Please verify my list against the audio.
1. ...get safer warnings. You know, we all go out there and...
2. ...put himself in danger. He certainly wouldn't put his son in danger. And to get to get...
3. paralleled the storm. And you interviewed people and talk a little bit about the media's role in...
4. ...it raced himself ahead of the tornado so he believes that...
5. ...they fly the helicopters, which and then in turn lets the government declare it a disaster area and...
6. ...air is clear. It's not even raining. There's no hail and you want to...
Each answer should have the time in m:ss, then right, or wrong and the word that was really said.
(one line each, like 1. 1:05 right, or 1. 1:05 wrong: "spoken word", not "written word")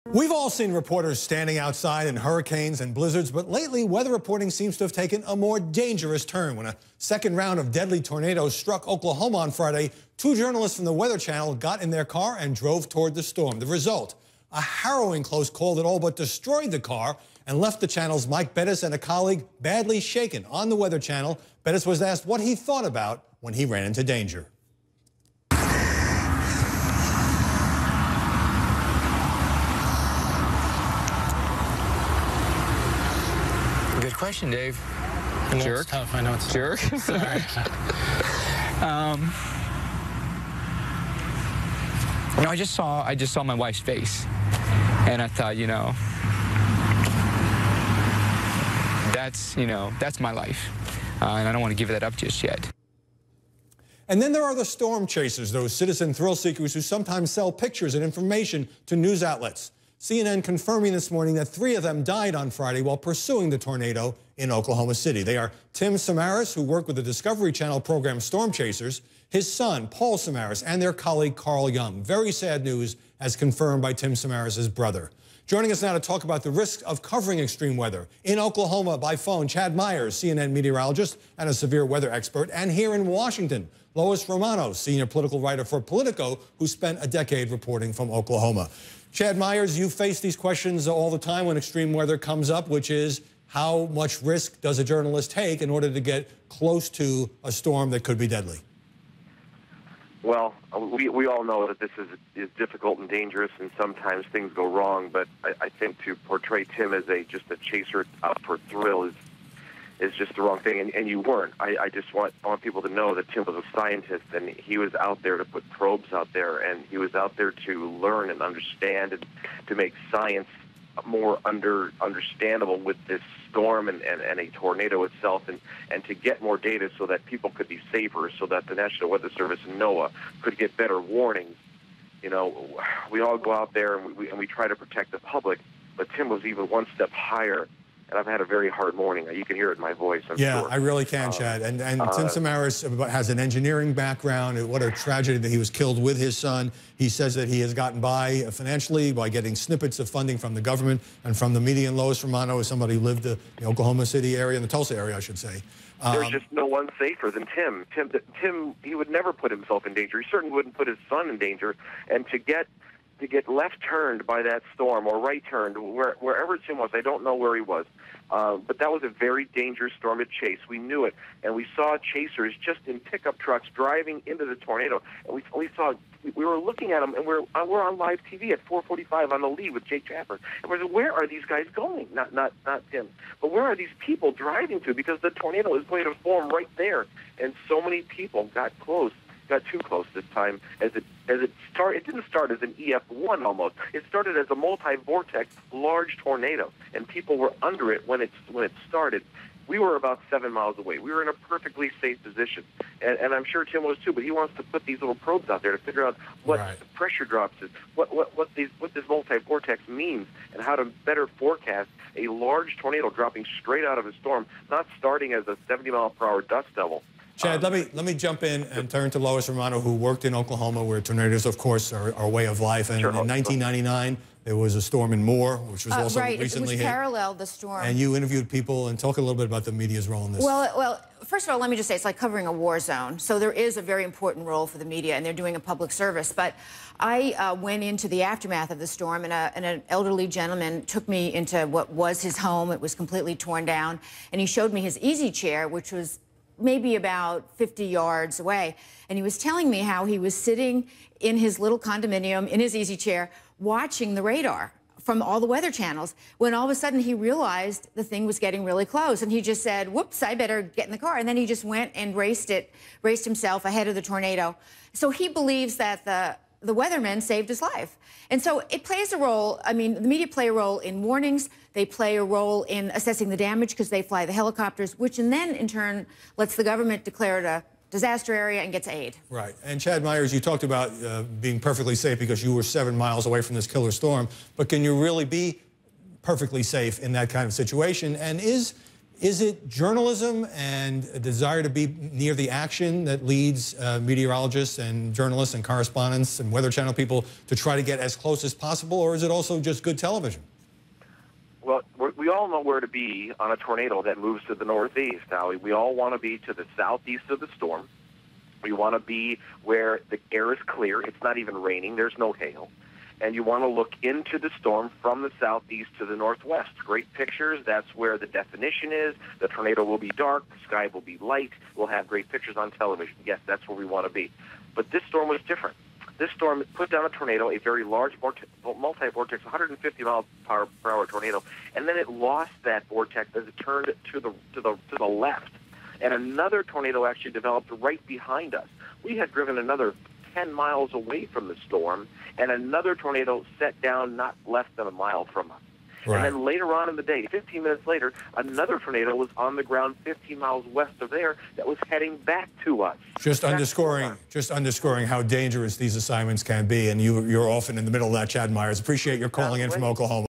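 1. 2:10 wrong: "better", not "safer"
2. 2:39 right
3. 3:46 right
4. 4:22 right
5. 4:33 right
6. 5:10 right.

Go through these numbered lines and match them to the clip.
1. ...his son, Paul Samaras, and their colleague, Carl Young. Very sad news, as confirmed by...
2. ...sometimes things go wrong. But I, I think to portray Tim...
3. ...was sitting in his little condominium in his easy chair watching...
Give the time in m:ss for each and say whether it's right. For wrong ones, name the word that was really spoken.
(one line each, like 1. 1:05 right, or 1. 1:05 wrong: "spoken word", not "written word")
1. 1:09 right
2. 1:43 right
3. 4:10 right.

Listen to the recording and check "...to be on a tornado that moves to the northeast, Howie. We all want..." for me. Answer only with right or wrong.
right.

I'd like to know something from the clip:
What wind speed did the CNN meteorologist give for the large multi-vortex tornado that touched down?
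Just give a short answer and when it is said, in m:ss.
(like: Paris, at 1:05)
150 mph, at 5:29.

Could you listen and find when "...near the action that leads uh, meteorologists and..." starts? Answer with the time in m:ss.
4:52.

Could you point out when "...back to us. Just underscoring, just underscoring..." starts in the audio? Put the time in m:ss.
5:52.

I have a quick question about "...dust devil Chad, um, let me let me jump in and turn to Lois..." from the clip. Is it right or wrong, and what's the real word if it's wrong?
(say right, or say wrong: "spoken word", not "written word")
right.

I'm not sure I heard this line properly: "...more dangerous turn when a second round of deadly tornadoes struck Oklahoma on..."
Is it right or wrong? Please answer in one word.
right.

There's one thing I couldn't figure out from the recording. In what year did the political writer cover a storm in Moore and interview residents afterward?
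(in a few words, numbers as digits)
1999.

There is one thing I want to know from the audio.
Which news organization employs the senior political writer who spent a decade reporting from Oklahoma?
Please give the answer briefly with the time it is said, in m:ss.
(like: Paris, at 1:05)
Politico, at 1:25.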